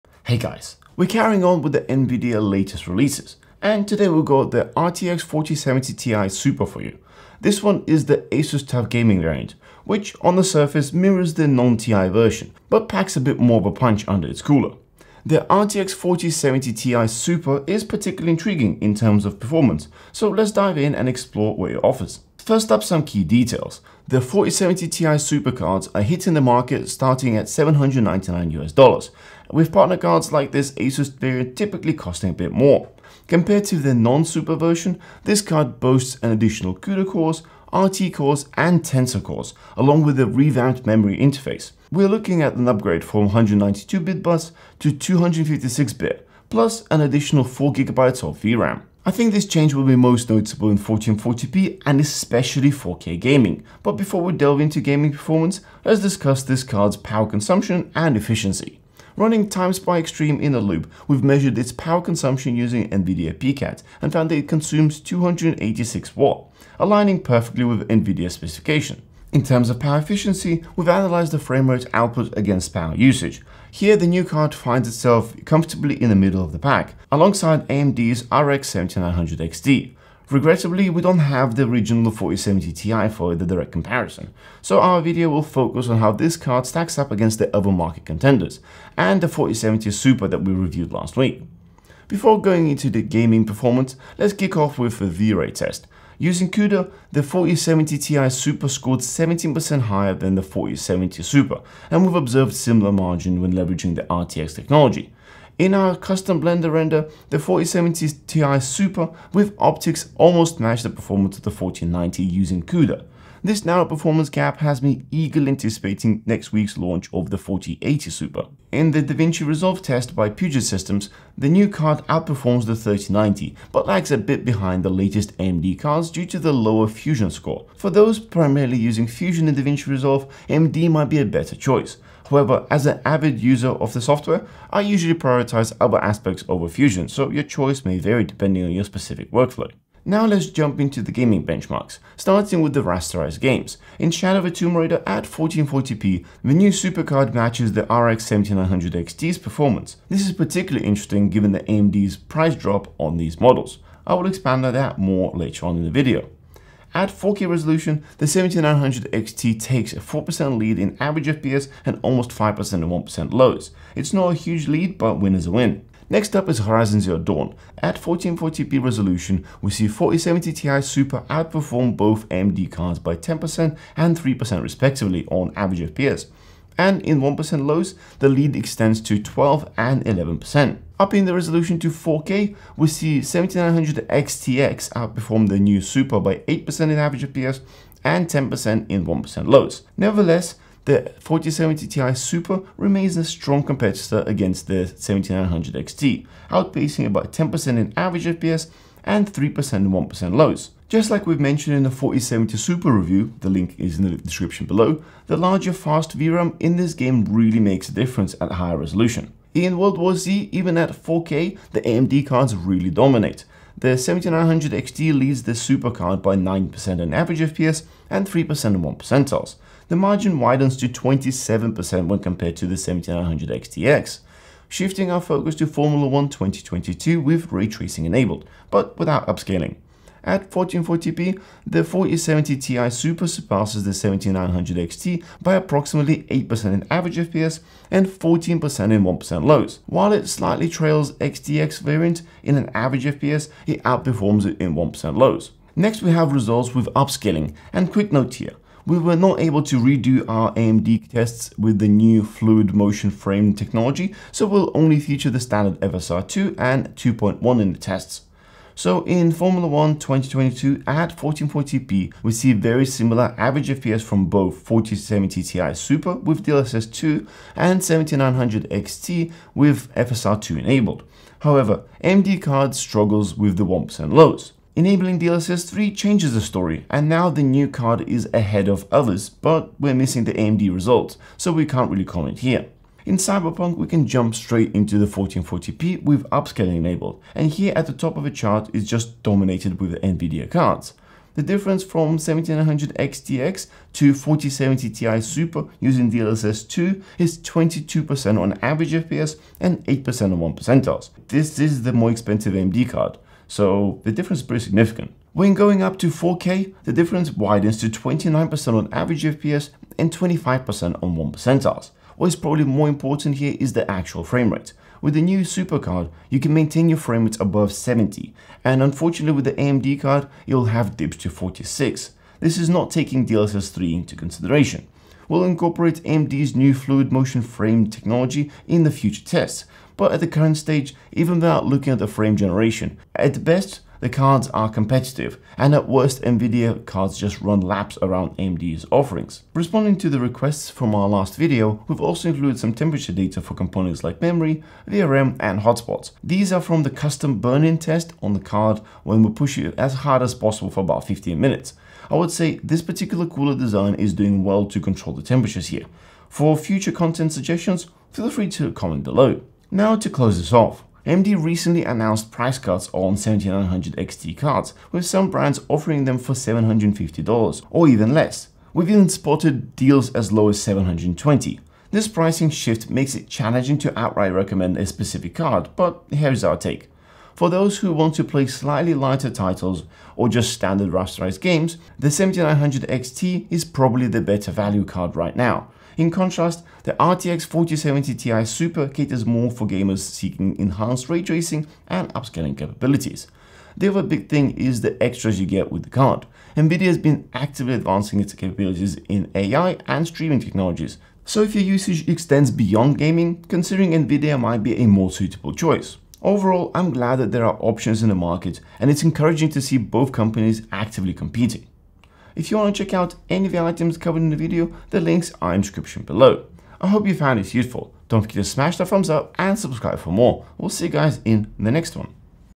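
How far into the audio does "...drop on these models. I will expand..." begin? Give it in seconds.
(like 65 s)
152 s.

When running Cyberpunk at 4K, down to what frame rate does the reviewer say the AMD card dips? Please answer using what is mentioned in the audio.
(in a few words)
46.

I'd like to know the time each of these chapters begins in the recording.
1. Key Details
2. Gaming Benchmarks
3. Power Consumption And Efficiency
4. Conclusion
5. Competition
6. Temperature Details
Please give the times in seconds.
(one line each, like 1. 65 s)
1. 22 s
2. 139 s
3. 53 s
4. 376 s
5. 359 s
6. 339 s.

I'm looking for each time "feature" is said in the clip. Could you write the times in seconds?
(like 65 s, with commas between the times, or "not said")
254 s.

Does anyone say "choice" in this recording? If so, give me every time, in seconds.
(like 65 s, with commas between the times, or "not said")
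131 s, 137 s, 405 s.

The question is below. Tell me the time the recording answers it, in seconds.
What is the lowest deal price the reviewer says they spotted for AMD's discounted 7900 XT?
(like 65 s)
370 s.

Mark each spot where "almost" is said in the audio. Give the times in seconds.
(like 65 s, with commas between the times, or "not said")
110 s, 162 s.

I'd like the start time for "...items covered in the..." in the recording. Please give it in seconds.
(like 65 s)
413 s.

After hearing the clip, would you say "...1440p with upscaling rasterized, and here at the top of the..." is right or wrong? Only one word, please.
wrong.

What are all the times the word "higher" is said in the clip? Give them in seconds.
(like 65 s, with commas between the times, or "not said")
99 s, 208 s.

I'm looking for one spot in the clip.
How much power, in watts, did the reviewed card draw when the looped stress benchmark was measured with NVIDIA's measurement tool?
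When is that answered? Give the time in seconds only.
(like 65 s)
64 s.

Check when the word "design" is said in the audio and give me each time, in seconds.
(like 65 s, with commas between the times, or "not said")
353 s.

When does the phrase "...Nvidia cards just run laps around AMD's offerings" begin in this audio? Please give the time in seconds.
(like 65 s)
336 s.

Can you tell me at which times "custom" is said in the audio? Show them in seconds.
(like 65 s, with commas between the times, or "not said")
105 s, 346 s.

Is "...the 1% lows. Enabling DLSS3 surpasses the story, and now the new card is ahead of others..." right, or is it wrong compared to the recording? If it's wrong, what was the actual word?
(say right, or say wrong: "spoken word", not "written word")
wrong: "changes", not "surpasses".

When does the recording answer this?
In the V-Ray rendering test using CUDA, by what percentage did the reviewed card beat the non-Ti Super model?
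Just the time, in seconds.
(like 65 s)
98 s.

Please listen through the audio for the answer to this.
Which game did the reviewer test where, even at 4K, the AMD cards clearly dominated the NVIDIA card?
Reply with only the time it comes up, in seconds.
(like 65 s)
209 s.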